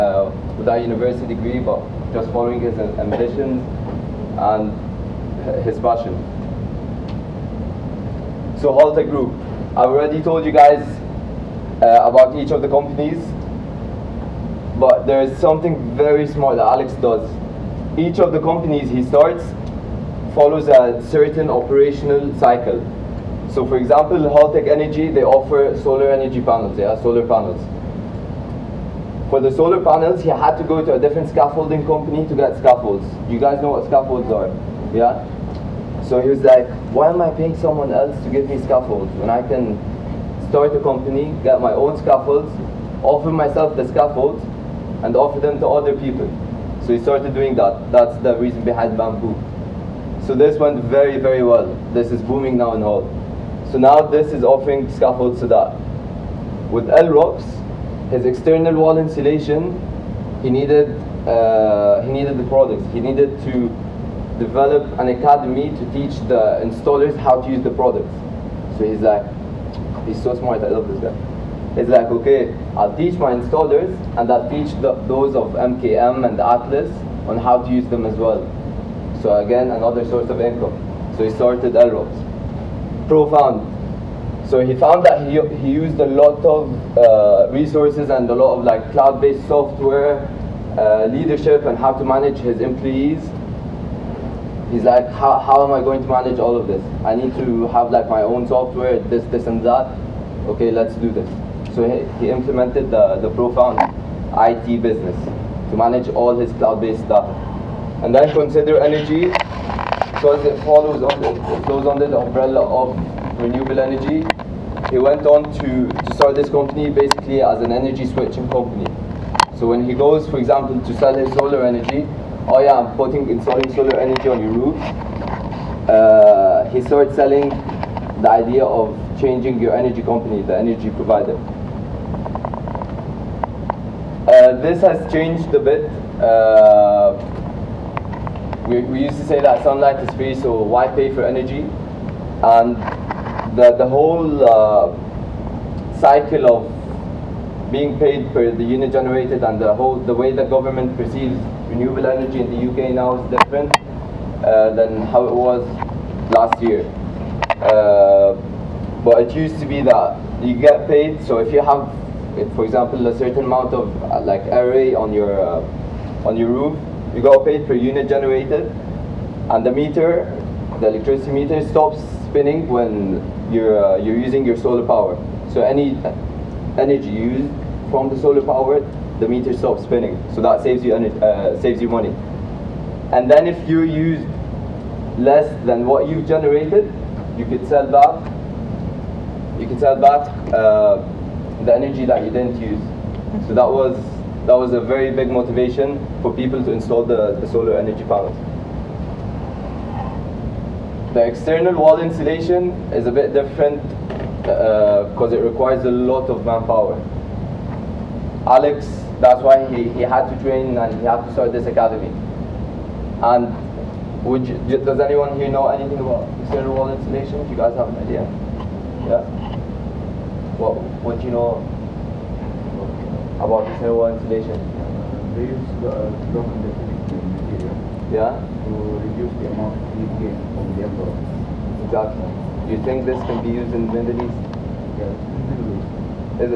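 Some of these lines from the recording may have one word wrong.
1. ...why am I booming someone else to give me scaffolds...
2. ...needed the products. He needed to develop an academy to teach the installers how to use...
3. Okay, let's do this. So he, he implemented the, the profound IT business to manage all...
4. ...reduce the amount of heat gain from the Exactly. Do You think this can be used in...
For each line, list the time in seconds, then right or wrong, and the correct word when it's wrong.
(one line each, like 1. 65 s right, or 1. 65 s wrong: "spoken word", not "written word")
1. 36 s wrong: "paying", not "booming"
2. 62 s right
3. 100 s right
4. 228 s right.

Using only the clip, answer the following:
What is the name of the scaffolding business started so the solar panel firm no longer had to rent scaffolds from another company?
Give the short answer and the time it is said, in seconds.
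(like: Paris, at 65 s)
Bamboo, at 48 s.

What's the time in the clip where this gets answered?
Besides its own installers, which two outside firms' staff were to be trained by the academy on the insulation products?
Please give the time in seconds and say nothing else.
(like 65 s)
75 s.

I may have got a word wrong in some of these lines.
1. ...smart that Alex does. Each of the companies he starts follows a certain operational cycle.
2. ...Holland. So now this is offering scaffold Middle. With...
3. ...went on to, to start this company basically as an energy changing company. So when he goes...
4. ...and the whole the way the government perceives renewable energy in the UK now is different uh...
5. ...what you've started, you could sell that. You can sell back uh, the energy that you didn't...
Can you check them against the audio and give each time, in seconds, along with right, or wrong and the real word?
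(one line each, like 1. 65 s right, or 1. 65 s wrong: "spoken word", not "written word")
1. 16 s right
2. 52 s wrong: "Sadat", not "Middle"
3. 114 s wrong: "switching", not "changing"
4. 149 s right
5. 185 s wrong: "generated", not "started".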